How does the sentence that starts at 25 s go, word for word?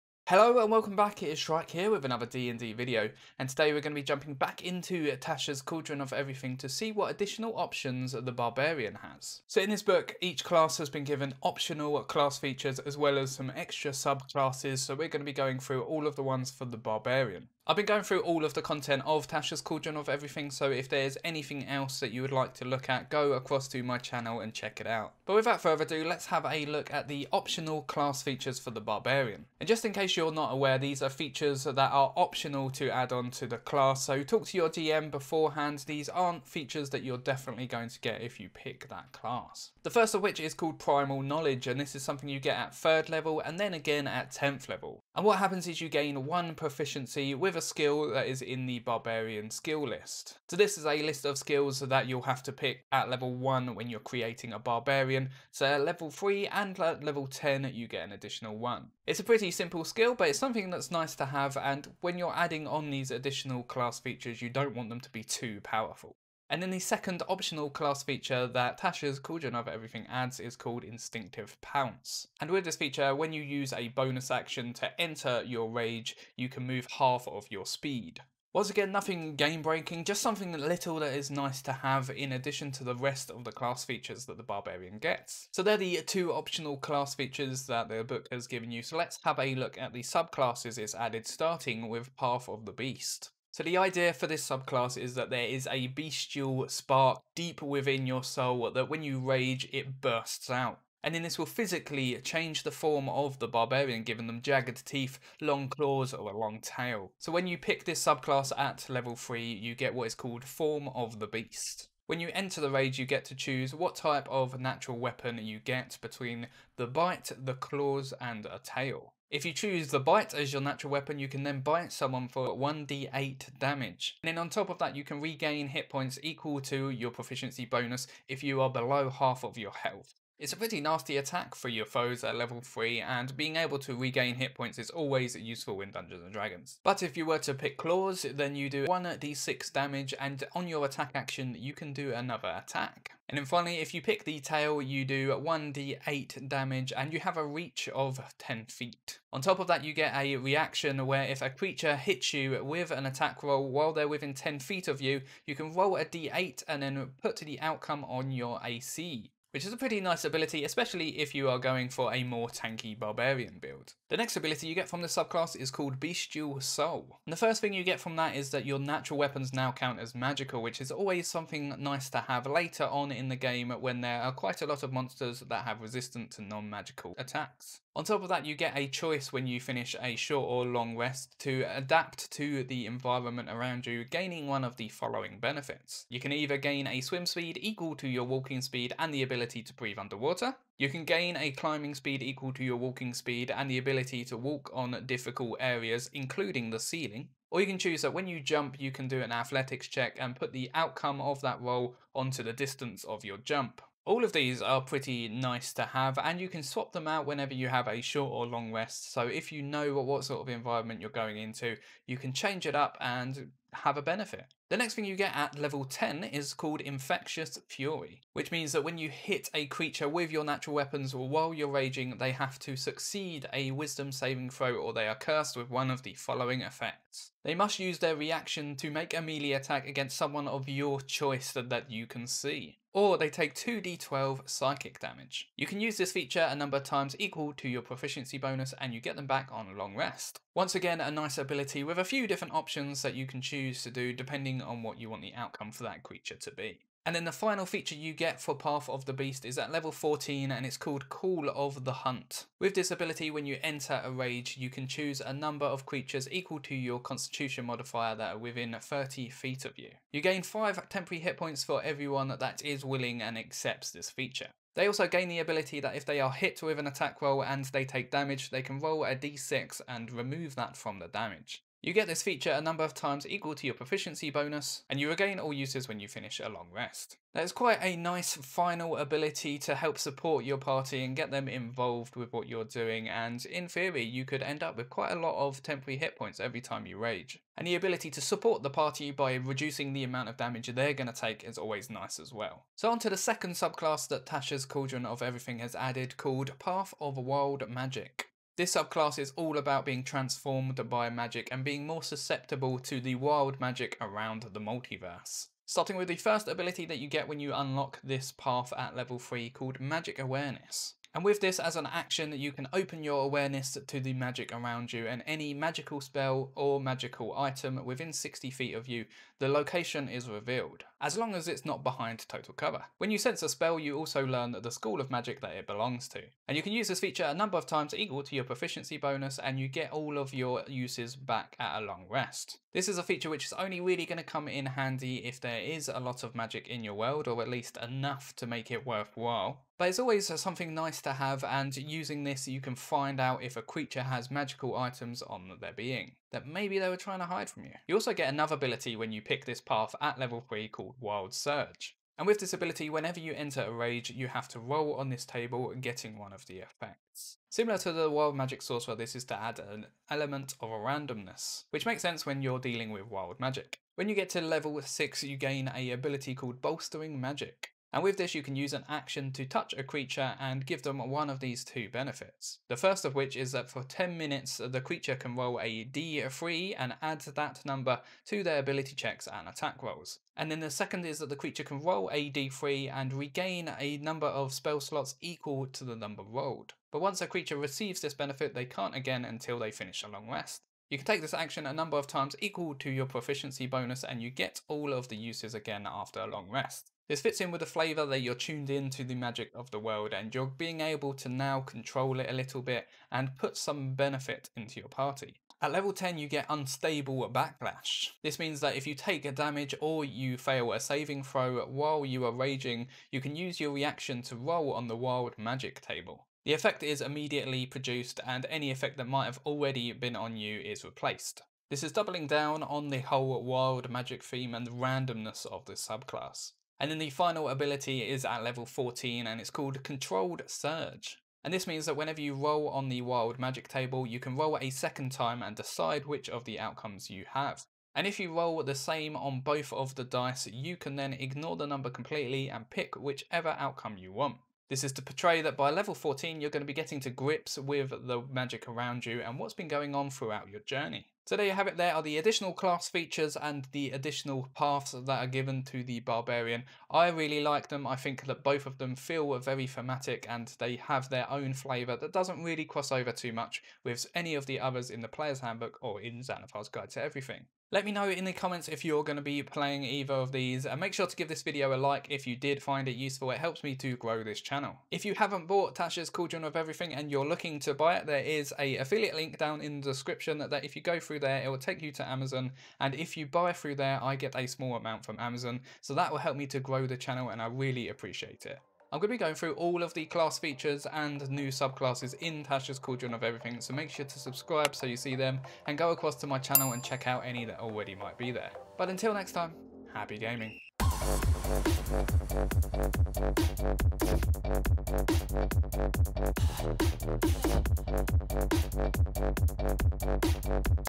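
But without further ado, let's have a look at the optional class features for the Barbarian.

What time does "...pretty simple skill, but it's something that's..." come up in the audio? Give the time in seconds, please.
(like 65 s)
59 s.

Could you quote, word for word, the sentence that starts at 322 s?
When you sense a spell, you also learn the school of magic that it belongs to.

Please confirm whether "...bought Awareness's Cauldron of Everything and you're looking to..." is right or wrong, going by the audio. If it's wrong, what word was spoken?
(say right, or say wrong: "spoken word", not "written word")
wrong: "Tasha", not "Awareness".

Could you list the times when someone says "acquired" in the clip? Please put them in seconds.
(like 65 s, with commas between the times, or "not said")
not said.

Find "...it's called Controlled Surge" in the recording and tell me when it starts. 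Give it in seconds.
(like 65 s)
429 s.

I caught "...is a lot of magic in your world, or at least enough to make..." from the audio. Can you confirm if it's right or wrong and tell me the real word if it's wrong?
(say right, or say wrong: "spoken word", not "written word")
right.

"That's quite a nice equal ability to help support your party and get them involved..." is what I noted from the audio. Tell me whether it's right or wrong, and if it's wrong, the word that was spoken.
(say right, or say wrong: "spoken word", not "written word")
wrong: "final", not "equal".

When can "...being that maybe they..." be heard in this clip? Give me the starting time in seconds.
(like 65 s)
345 s.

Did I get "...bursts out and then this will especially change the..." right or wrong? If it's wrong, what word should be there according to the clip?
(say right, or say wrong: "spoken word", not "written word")
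wrong: "physically", not "especially".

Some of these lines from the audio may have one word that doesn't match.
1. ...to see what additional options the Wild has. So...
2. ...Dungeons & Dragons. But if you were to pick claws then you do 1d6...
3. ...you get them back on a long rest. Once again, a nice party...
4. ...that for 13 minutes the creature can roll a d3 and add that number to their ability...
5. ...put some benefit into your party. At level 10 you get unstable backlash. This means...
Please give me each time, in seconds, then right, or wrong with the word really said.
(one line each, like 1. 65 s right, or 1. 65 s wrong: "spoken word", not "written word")
1. 6 s wrong: "Barbarian", not "Wild"
2. 135 s right
3. 238 s wrong: "ability", not "party"
4. 373 s wrong: "10", not "13"
5. 403 s right.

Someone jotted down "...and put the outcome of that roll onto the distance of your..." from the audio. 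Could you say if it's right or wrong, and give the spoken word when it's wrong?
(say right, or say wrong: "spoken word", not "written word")
right.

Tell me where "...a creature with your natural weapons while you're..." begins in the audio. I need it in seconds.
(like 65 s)
219 s.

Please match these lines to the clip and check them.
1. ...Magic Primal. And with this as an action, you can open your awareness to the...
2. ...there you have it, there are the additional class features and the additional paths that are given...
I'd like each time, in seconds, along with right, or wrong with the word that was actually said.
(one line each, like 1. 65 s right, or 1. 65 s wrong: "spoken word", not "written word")
1. 309 s wrong: "Awareness", not "Primal"
2. 451 s right.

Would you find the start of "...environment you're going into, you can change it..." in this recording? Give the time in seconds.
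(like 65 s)
210 s.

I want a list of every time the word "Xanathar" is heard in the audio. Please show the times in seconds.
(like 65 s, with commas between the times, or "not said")
466 s.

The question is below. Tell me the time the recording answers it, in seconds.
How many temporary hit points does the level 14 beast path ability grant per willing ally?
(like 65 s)
260 s.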